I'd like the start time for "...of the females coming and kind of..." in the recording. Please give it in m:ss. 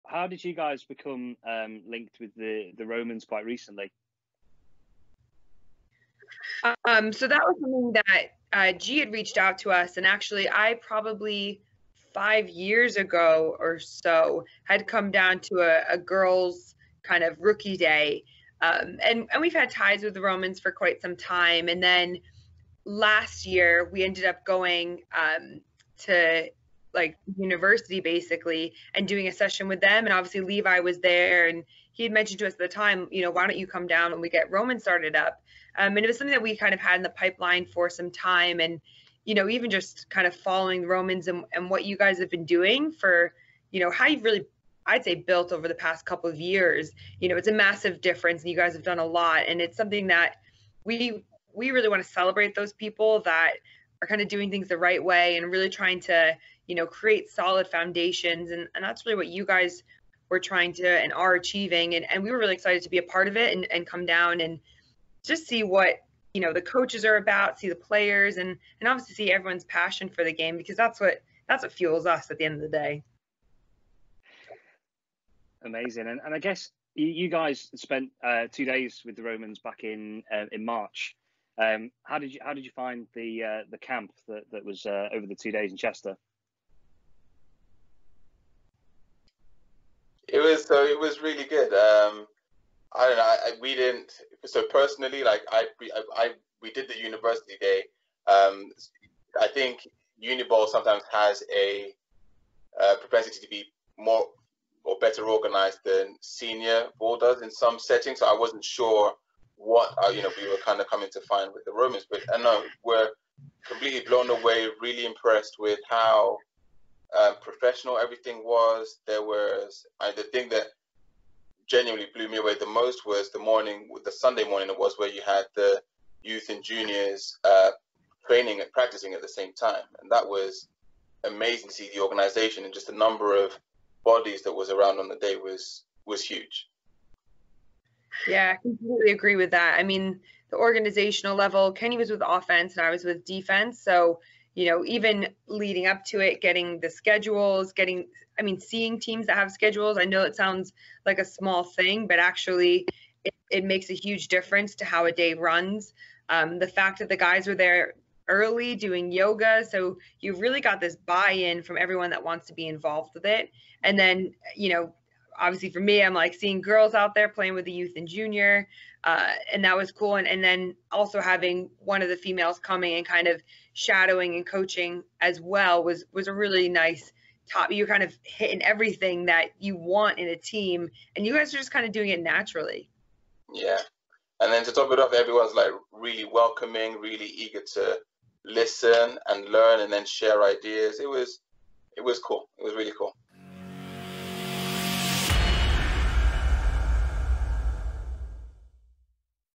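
2:52.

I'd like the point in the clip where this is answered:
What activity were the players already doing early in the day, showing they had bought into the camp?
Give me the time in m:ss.
2:39.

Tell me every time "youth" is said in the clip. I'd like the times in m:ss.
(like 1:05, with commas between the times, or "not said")
2:06, 2:47.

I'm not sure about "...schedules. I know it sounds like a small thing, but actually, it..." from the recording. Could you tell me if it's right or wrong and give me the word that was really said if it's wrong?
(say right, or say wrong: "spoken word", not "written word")
right.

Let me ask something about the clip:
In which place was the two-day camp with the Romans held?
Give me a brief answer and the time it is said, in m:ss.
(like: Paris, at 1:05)
Chester, at 1:25.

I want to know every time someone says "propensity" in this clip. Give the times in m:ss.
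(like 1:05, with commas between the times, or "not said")
1:43.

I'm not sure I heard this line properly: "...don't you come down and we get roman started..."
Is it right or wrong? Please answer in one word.
right.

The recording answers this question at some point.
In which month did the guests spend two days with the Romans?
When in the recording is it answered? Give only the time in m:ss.
1:20.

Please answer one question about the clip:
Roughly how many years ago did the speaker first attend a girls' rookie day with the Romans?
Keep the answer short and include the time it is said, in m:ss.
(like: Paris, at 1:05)
5, at 0:12.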